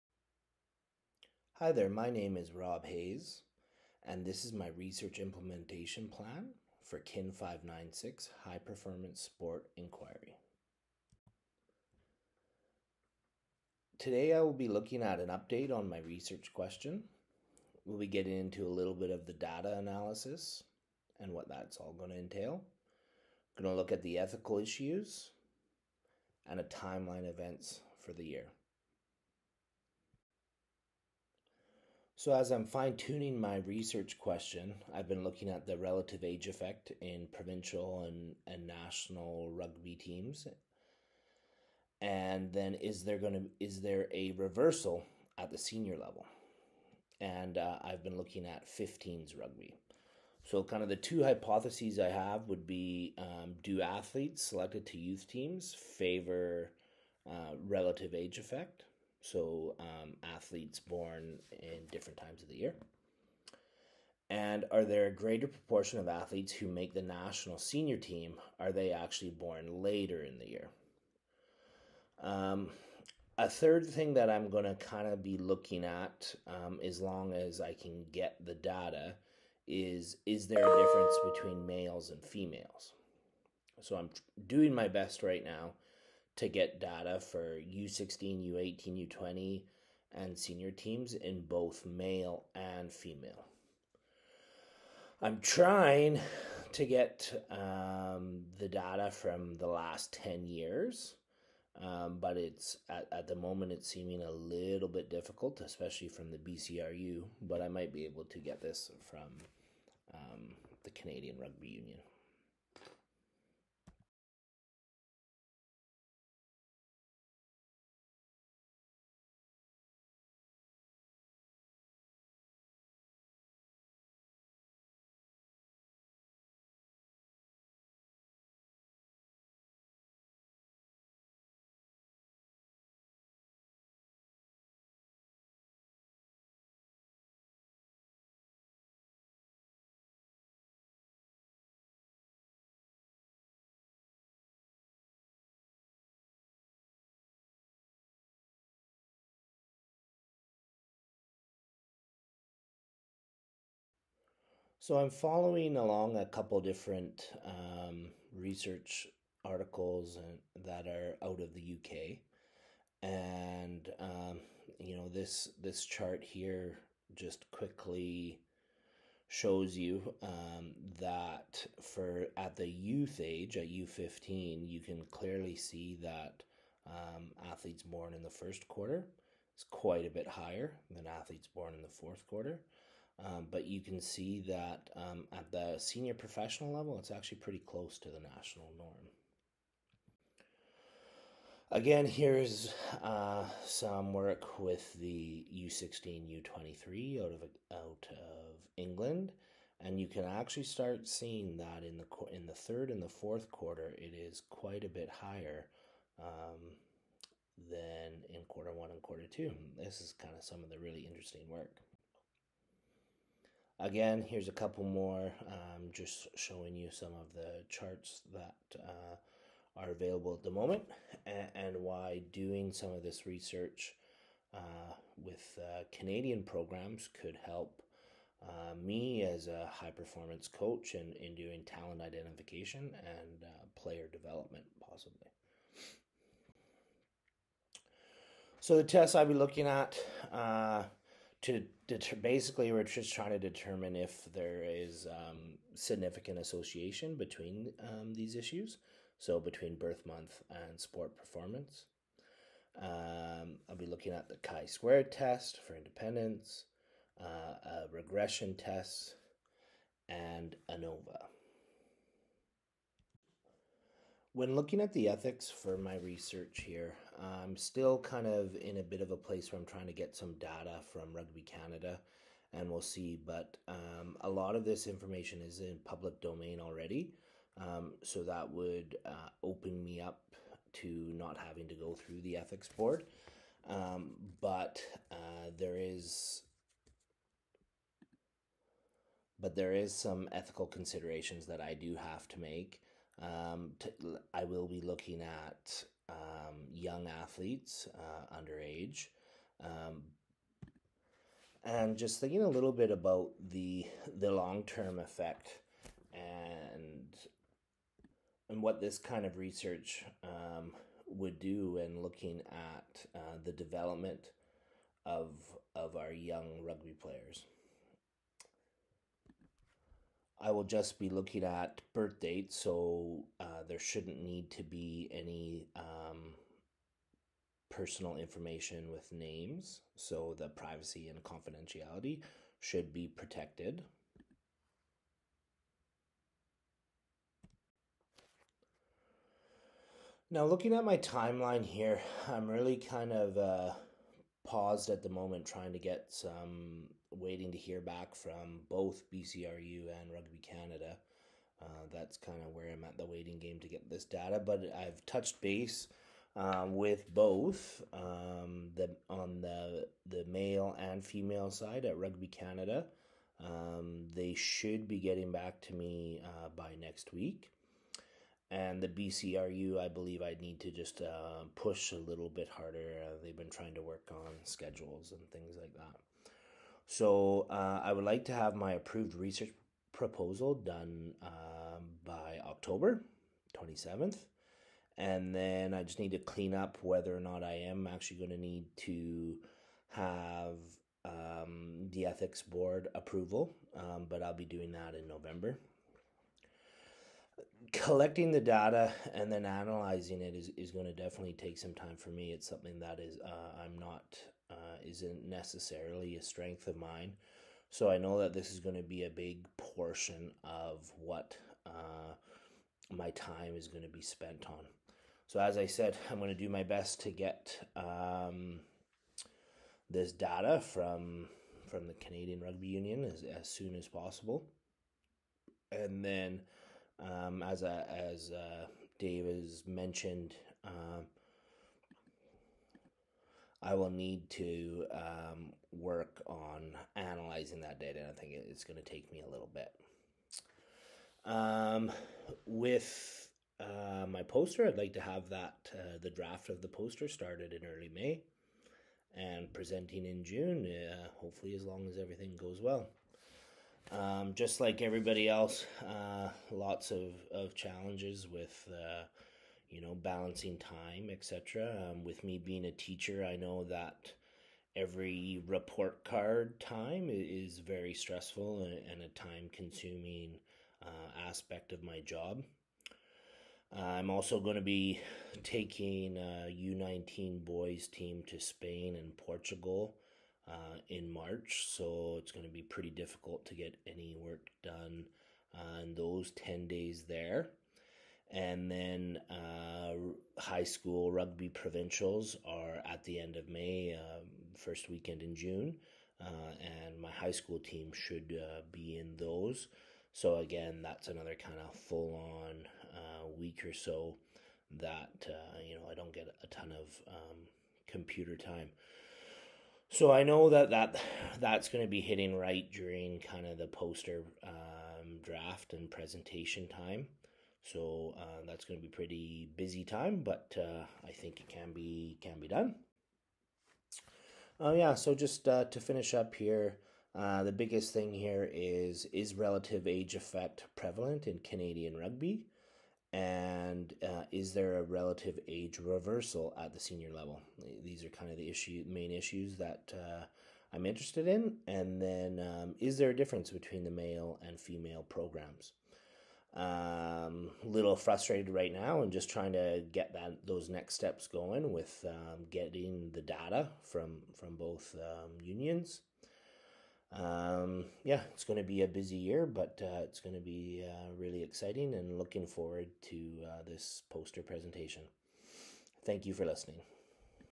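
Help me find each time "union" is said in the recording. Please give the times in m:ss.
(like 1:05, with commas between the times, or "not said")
1:51, 7:02, 9:15.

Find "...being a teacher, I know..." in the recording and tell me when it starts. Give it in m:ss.
7:42.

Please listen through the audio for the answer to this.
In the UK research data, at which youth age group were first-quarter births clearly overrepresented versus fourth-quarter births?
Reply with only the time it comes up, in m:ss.
2:53.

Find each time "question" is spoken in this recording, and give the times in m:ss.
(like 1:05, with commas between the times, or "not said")
0:16, 0:34.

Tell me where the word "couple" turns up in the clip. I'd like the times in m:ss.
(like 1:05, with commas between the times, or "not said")
2:36, 3:34.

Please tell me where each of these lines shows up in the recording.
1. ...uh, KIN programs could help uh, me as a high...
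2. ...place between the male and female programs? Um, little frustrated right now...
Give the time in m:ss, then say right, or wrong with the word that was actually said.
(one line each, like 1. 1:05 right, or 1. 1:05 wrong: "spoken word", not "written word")
1. 3:45 wrong: "Canadian", not "KIN"
2. 9:03 wrong: "difference", not "place".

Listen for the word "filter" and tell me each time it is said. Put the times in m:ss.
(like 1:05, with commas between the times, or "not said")
not said.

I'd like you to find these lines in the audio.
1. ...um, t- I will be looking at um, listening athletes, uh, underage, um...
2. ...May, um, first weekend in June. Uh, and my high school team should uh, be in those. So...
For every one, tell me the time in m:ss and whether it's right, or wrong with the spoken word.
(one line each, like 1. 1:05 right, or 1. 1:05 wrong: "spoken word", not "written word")
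1. 4:53 wrong: "young", not "listening"
2. 8:13 right.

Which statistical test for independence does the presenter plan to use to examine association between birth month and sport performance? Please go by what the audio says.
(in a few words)
Chi-squared test.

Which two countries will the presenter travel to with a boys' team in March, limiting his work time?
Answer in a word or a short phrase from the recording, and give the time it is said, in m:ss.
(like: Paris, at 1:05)
Spain and Portugal, at 7:58.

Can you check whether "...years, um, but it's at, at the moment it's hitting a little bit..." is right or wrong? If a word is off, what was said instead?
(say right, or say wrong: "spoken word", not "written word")
wrong: "seeming", not "hitting".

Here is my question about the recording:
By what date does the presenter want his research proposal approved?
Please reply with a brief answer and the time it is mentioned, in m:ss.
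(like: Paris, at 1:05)
October 27th, at 6:22.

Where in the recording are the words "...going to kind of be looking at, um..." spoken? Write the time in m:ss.
1:14.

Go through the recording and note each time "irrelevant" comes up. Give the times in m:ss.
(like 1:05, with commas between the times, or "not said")
not said.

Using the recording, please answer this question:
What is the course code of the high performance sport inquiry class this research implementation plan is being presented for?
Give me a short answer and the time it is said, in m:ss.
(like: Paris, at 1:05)
KIN 596, at 0:06.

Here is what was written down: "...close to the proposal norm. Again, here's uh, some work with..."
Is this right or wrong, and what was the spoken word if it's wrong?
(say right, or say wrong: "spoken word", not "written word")
wrong: "national", not "proposal".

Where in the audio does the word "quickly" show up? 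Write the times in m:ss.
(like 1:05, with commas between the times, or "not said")
2:47.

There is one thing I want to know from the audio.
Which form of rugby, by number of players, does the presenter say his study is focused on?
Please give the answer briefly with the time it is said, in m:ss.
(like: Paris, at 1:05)
15s rugby, at 0:48.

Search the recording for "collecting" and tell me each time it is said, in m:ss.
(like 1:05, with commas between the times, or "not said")
6:37.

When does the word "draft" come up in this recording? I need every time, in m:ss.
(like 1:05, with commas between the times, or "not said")
7:26, 8:35.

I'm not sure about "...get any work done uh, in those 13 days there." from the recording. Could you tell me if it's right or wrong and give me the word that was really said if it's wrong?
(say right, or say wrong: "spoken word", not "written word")
wrong: "10", not "13".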